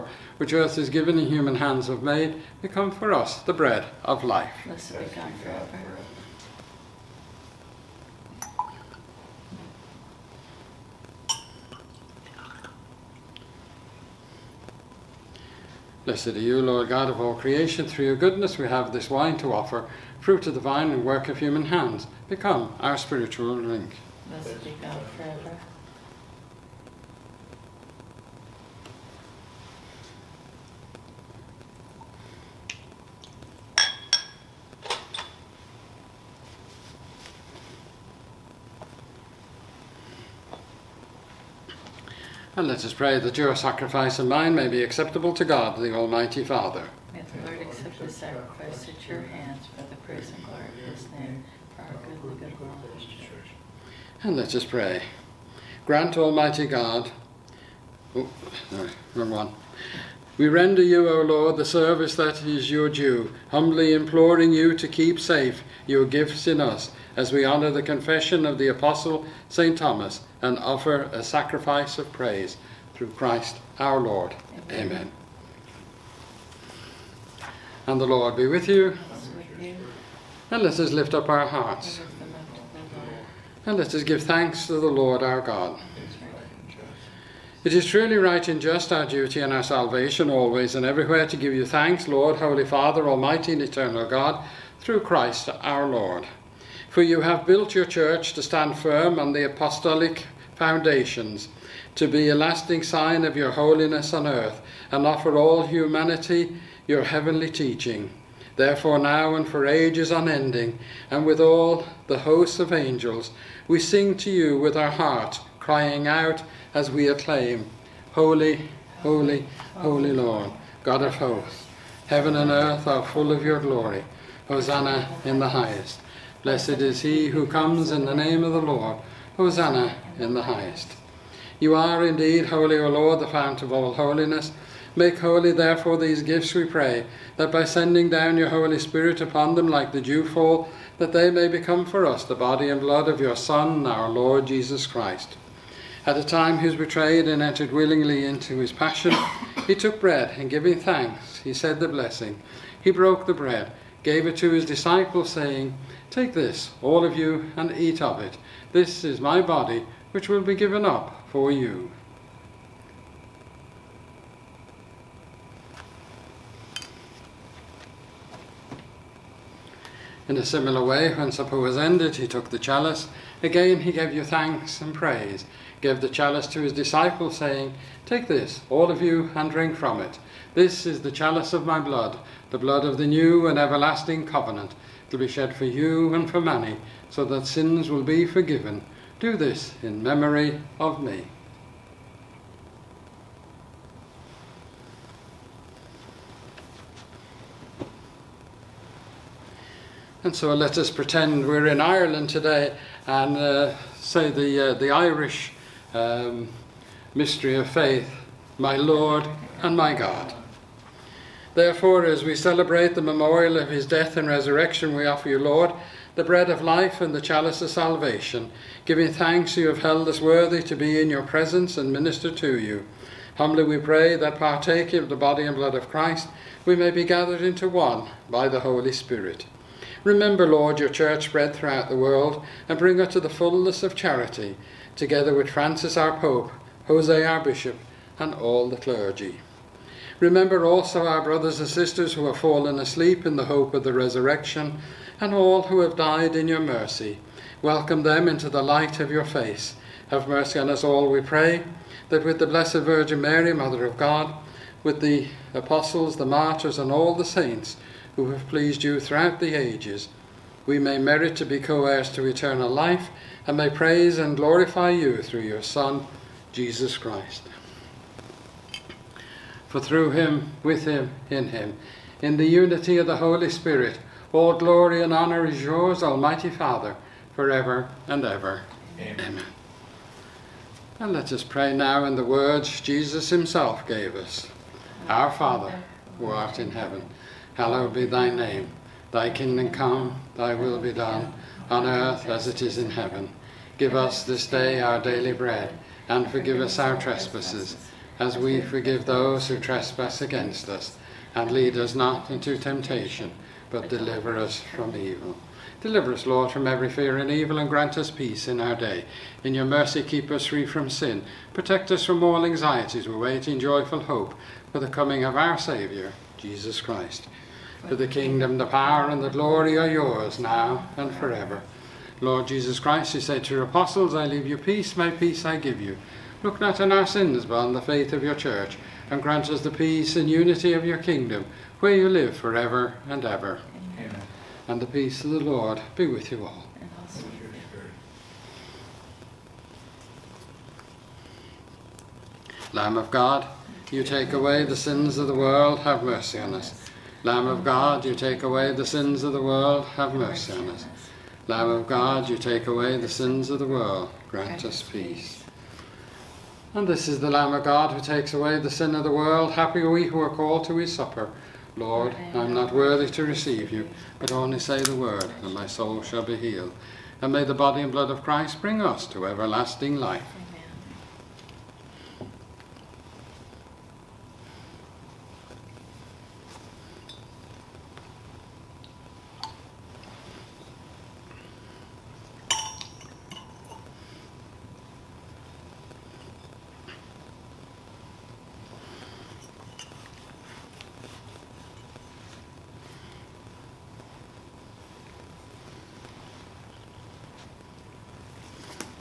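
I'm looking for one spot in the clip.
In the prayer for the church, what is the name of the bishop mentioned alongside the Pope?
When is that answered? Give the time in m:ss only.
3:56.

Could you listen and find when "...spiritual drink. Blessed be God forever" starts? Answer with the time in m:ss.
0:22.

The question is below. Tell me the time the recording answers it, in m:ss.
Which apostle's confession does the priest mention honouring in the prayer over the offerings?
1:09.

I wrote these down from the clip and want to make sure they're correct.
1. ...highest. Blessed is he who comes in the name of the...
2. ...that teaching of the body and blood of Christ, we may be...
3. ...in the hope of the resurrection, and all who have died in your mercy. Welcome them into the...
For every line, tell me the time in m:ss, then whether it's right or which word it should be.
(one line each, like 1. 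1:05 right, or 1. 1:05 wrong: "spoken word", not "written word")
1. 2:05 right
2. 3:44 wrong: "partaking", not "teaching"
3. 4:03 right.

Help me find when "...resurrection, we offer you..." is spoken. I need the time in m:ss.
3:34.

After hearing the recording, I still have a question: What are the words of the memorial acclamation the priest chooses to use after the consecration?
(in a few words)
My Lord and my God.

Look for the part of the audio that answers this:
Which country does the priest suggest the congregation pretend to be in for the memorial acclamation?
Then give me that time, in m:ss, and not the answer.
3:21.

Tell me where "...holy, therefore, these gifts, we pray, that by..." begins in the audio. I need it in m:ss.
2:15.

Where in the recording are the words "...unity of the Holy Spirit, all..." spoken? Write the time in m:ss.
4:32.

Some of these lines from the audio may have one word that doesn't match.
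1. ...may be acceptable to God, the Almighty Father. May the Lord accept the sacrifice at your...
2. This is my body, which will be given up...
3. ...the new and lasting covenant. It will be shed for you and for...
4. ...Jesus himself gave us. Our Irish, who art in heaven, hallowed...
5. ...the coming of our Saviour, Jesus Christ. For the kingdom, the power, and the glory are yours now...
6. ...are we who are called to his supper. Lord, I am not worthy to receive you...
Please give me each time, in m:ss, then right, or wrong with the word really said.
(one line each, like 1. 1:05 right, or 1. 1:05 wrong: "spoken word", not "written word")
1. 0:44 right
2. 2:38 right
3. 3:02 wrong: "everlasting", not "lasting"
4. 4:42 wrong: "Father", not "Irish"
5. 5:14 right
6. 5:59 right.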